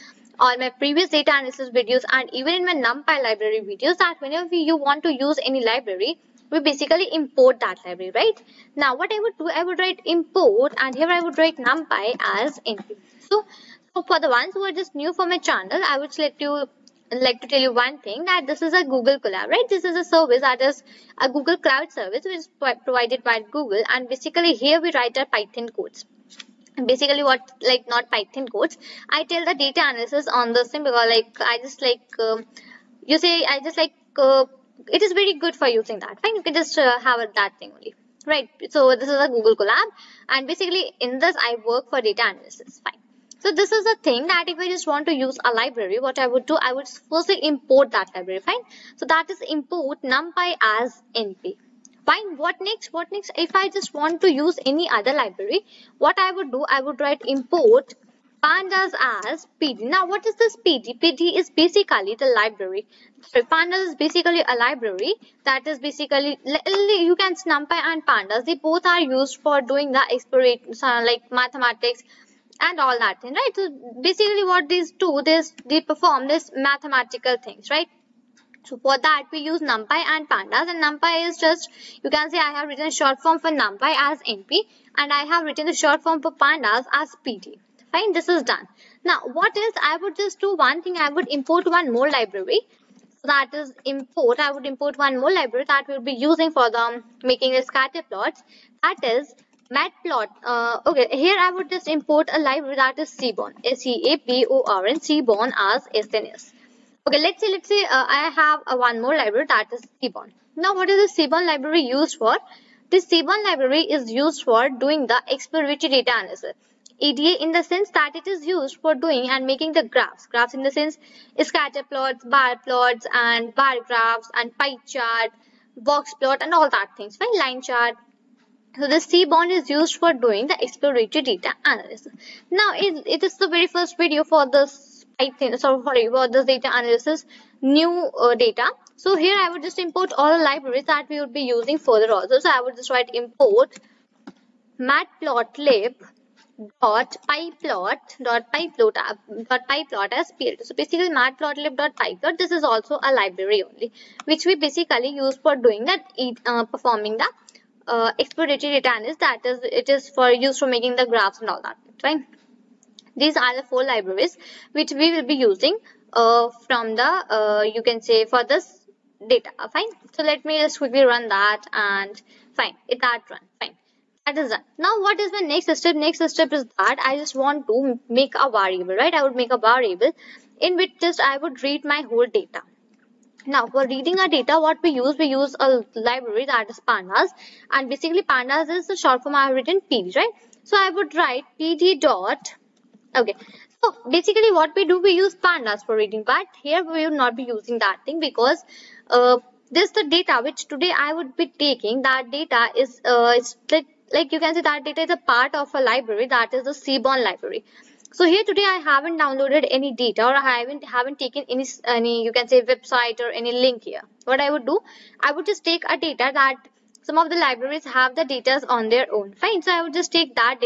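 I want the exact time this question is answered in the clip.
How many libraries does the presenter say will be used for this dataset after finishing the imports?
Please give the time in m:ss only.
2:43.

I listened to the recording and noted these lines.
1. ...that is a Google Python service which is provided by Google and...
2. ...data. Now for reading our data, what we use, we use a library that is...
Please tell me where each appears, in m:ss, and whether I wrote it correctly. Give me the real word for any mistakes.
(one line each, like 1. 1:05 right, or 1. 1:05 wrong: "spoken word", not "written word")
1. 0:20 wrong: "Cloud", not "Python"
2. 3:02 right.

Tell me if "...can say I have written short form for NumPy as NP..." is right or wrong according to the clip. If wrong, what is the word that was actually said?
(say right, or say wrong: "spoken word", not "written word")
right.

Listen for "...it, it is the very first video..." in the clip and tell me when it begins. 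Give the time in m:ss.
2:12.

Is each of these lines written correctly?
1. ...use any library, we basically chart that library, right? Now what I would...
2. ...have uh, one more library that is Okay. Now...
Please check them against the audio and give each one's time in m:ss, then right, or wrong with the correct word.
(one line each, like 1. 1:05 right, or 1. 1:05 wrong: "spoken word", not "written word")
1. 0:05 wrong: "import", not "chart"
2. 1:48 wrong: "Seaborn", not "Okay".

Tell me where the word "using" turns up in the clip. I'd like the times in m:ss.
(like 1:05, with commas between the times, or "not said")
0:35, 1:36, 2:21, 2:45, 3:17.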